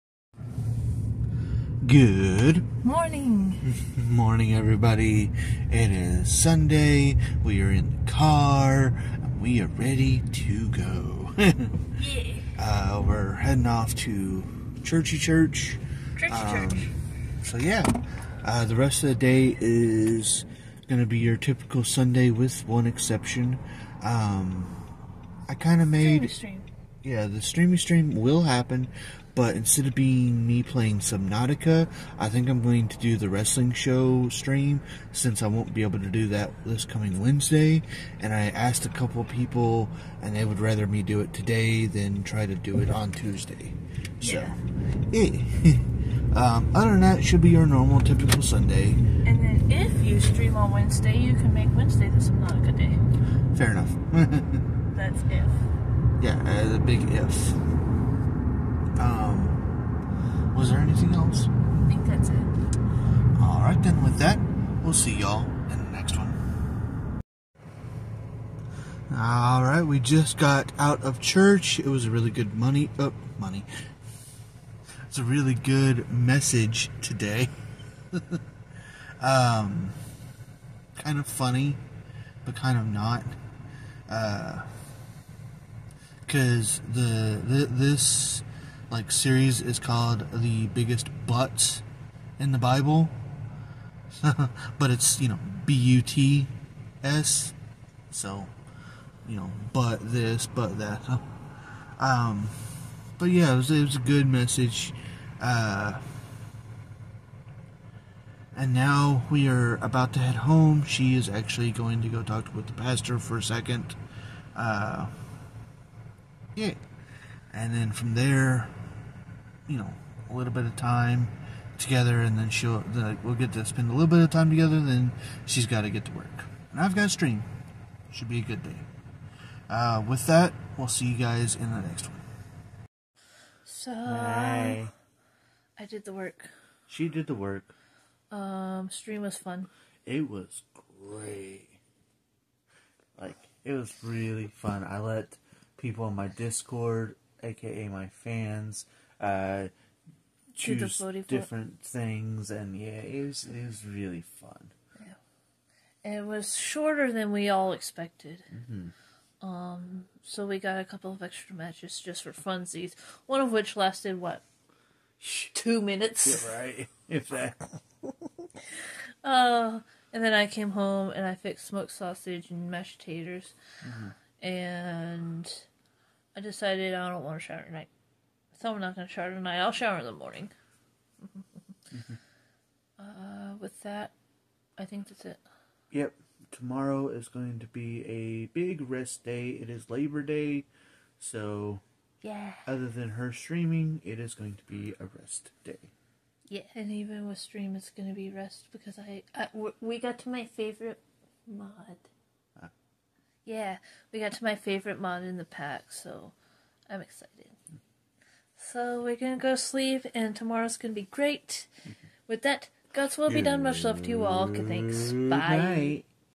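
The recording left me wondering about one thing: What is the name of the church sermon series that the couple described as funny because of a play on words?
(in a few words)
The biggest buts in the Bible.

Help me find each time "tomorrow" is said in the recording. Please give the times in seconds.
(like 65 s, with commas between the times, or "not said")
186 s, 210 s.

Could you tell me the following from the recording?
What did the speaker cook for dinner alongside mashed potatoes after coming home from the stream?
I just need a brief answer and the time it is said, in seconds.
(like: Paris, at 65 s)
Smoked sausage, at 171 s.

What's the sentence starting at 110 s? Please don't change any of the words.
She is actually going to go talk with the pastor for a second.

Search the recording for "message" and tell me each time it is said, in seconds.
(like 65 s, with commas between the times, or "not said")
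76 s, 104 s.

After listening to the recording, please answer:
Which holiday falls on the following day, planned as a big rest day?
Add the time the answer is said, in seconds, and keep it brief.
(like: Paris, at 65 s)
Labor Day, at 189 s.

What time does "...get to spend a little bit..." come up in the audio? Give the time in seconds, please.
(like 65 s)
123 s.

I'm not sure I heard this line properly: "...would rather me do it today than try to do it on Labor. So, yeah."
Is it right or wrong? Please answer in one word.
wrong.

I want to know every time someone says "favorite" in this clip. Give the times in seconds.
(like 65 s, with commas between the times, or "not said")
200 s, 204 s.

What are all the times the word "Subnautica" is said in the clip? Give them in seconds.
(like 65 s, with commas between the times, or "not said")
30 s, 52 s.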